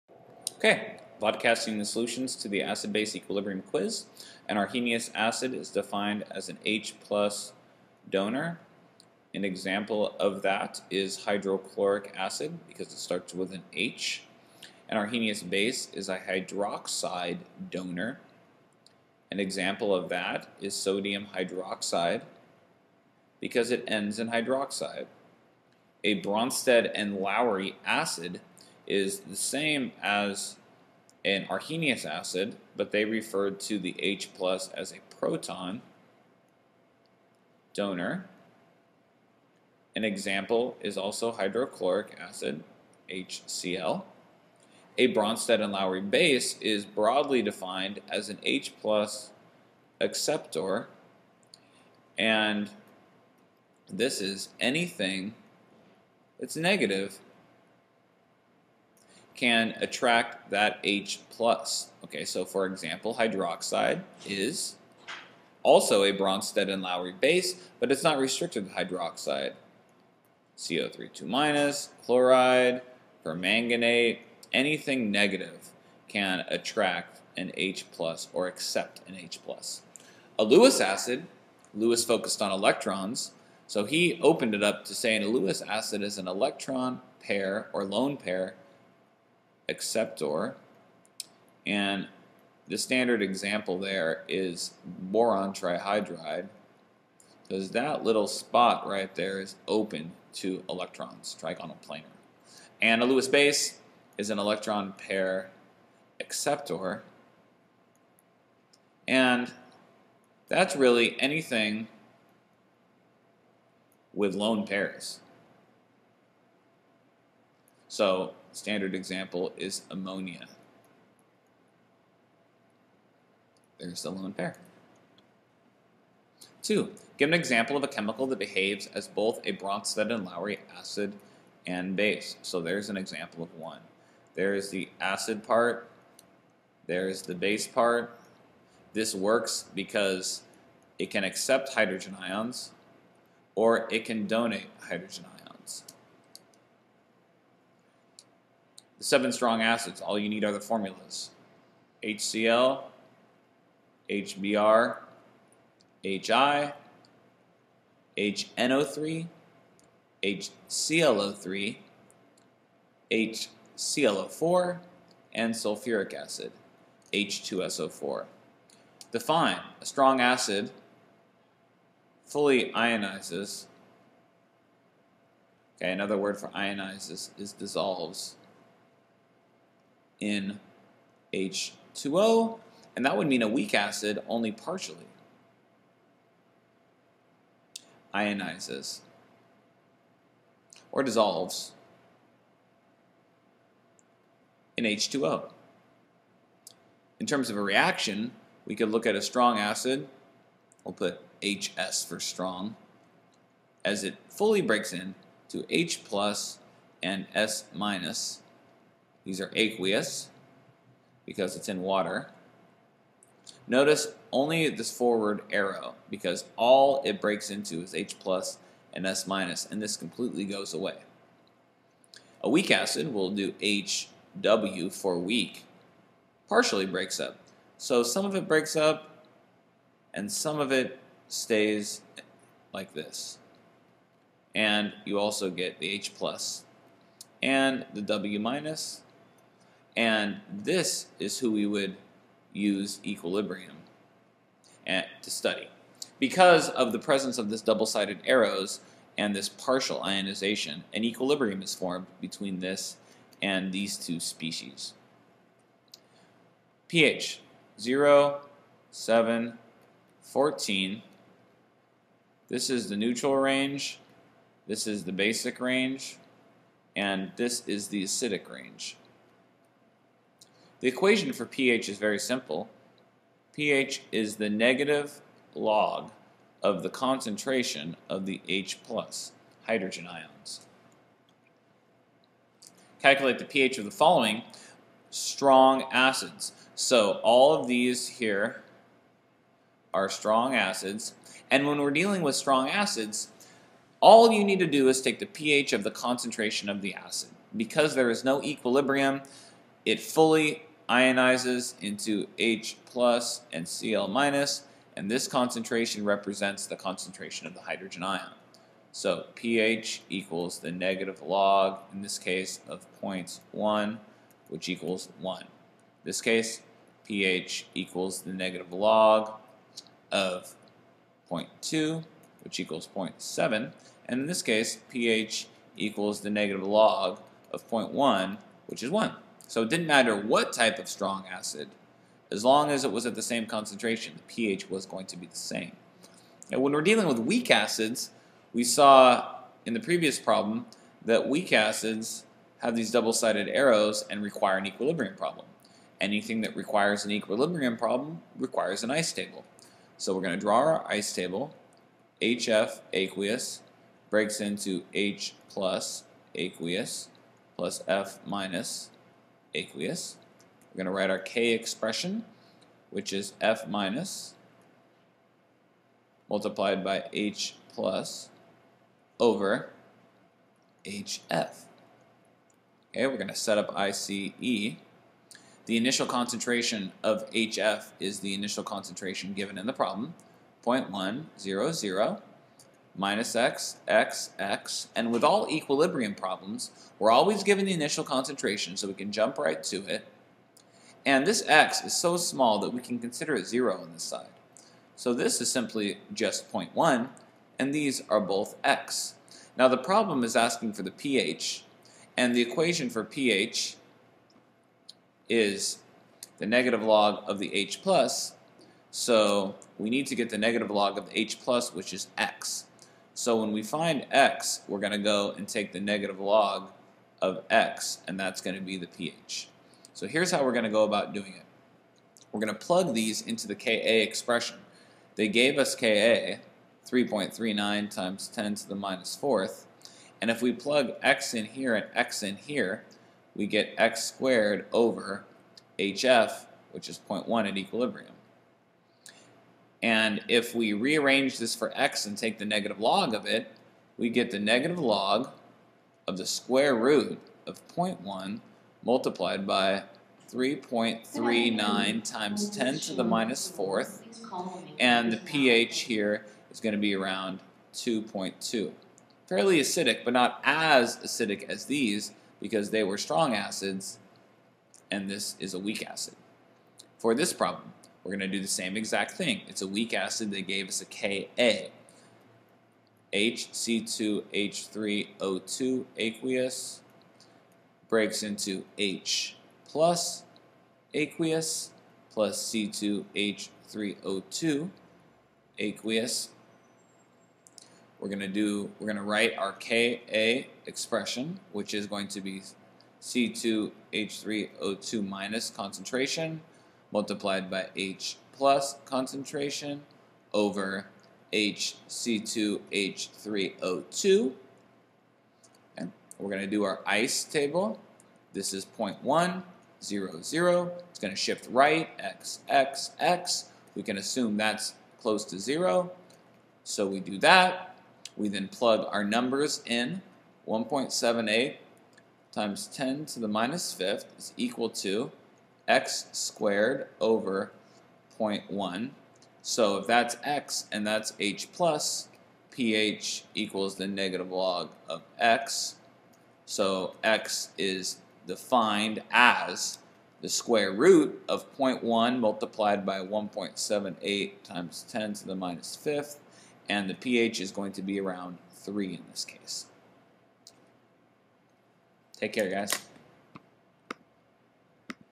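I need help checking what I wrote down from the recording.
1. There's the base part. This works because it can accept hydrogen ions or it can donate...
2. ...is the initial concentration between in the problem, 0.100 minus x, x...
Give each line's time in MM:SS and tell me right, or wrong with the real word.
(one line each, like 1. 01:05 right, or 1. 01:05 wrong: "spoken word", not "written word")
1. 02:16 right
2. 06:17 wrong: "given", not "between".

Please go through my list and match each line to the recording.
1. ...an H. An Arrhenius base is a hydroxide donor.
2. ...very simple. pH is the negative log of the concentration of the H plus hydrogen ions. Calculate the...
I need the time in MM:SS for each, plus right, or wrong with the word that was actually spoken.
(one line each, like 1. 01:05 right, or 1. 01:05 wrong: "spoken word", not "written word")
1. 00:13 right
2. 04:31 right.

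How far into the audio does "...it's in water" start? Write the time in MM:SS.
03:31.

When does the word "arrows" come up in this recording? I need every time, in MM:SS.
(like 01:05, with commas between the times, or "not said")
03:35, 04:08, 05:43.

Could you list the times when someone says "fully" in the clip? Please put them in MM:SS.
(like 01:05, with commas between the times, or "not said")
02:52, 03:24, 04:59.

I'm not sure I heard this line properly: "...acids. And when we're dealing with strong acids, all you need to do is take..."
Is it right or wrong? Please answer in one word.
right.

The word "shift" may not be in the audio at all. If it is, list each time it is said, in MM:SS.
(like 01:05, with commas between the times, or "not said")
08:31.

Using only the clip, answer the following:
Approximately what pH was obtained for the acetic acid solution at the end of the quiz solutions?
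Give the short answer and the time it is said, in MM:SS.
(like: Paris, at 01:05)
3, at 09:07.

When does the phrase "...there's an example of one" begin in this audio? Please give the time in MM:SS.
02:12.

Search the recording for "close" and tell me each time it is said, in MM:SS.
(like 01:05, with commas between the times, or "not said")
08:35.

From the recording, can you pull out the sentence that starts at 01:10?
co 3 minus, chloride, permanganate, anything negative can attract an H plus or accept an H plus.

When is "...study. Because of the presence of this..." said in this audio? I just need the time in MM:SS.
04:05.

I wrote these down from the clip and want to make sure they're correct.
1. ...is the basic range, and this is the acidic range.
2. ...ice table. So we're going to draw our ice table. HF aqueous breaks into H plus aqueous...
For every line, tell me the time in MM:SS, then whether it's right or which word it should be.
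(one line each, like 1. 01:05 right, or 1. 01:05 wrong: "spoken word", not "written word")
1. 04:24 right
2. 05:48 right.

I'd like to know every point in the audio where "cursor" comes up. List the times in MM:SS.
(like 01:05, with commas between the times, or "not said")
not said.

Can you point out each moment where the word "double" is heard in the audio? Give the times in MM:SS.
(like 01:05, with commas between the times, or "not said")
04:07, 05:42.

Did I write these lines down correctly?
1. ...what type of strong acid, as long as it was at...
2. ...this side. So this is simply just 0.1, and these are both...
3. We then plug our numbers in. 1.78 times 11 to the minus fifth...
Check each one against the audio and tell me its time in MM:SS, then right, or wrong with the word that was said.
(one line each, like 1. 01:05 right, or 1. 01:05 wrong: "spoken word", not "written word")
1. 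05:30 right
2. 06:33 right
3. 08:38 wrong: "10", not "11".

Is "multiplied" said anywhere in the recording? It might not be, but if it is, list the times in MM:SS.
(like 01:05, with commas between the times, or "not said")
06:06, 07:28, 08:16, 09:02.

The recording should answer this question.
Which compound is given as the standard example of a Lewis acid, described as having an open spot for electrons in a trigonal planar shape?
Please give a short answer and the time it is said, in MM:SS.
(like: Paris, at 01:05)
boron trihydride, at 01:34.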